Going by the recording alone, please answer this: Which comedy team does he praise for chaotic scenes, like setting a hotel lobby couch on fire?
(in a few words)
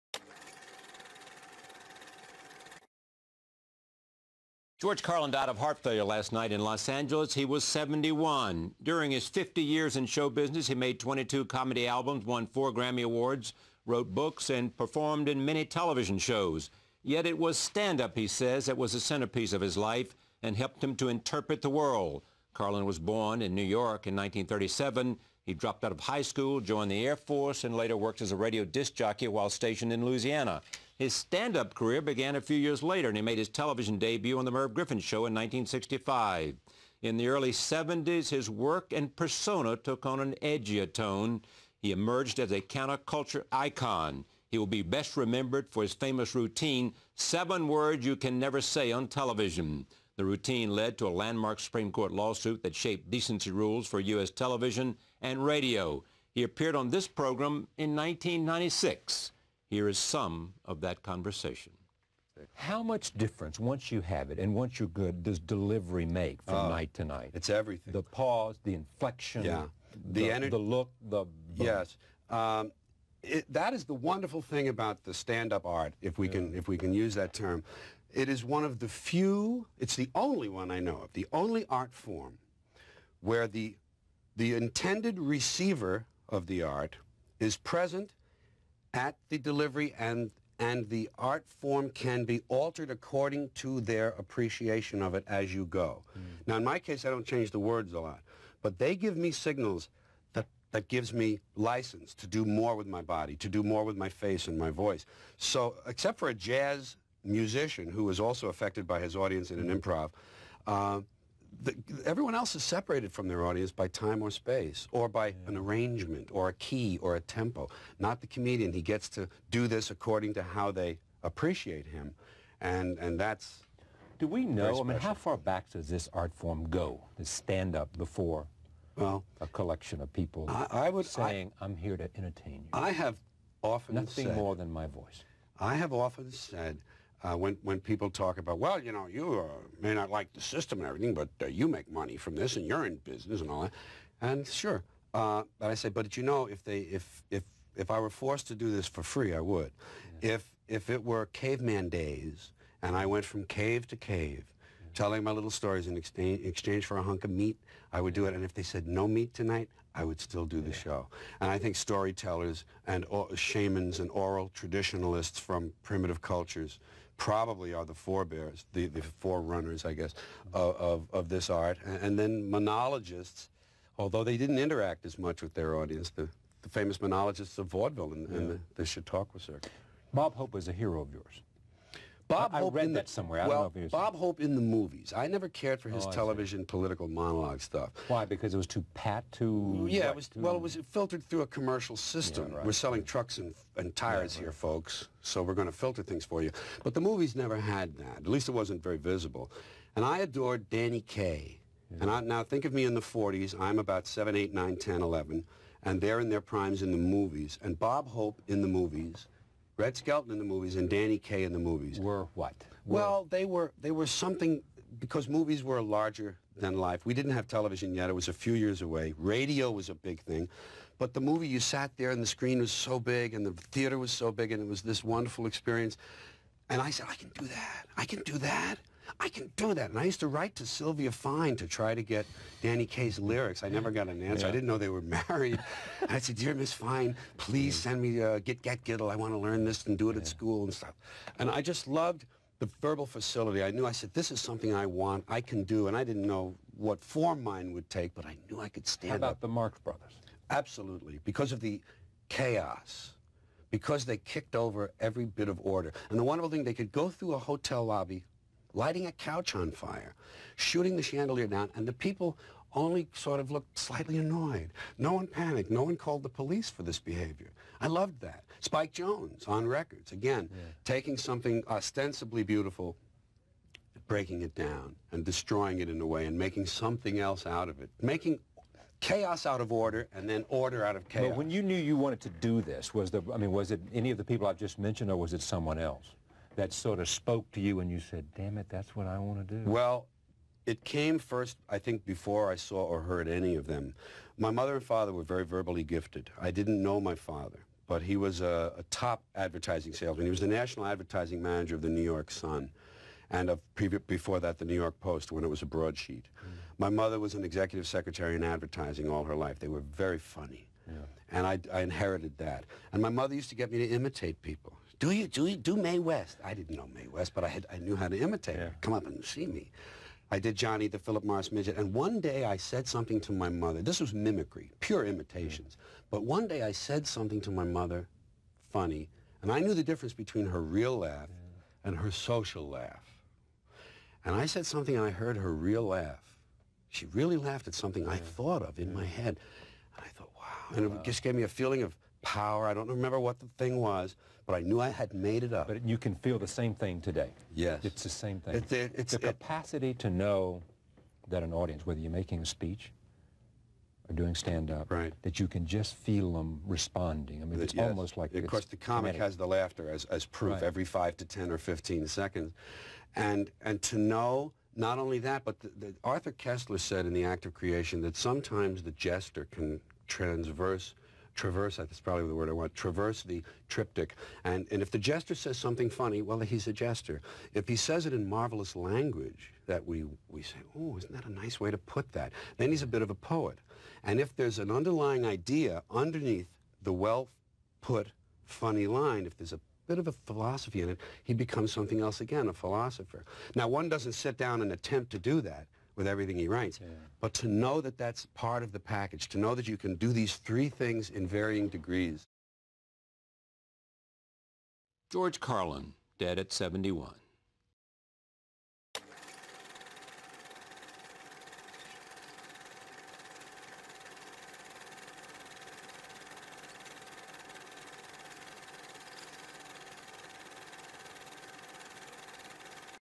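The Marx Brothers.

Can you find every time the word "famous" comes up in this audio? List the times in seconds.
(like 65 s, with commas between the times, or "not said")
45 s, 176 s.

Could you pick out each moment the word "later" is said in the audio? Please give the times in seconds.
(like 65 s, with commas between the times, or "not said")
27 s, 32 s.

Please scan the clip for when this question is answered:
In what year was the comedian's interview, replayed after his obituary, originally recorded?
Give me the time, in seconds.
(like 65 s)
57 s.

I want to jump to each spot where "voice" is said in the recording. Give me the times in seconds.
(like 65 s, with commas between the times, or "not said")
104 s, 134 s.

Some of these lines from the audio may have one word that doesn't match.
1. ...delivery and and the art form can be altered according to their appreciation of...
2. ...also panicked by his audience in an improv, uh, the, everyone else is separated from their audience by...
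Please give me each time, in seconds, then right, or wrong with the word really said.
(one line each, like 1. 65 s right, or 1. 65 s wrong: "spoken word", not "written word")
1. 89 s right
2. 108 s wrong: "affected", not "panicked".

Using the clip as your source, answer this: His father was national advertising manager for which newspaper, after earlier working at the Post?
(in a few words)
New York Sun.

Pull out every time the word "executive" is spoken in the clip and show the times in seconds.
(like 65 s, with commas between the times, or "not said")
307 s.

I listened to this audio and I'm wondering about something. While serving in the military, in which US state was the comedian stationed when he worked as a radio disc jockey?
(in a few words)
Louisiana.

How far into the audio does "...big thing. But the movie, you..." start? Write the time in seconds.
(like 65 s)
219 s.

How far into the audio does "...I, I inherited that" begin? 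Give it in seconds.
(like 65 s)
311 s.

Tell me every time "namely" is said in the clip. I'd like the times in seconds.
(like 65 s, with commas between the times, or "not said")
not said.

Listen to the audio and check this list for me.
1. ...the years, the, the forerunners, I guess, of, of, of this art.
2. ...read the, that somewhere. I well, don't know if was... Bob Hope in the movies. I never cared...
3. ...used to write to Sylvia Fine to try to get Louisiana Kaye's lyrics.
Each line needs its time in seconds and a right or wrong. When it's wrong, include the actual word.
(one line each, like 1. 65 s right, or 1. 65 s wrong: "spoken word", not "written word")
1. 167 s wrong: "forebears", not "years"
2. 182 s right
3. 230 s wrong: "Danny", not "Louisiana".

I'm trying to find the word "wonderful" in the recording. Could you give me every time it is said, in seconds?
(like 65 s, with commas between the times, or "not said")
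73 s, 225 s, 256 s.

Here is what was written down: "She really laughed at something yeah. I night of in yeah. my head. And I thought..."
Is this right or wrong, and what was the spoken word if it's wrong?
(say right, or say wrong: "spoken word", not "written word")
wrong: "thought", not "night".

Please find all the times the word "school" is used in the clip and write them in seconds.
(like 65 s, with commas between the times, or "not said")
26 s, 240 s.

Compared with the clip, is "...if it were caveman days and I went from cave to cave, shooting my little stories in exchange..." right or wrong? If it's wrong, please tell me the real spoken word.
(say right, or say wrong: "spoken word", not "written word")
wrong: "telling", not "shooting".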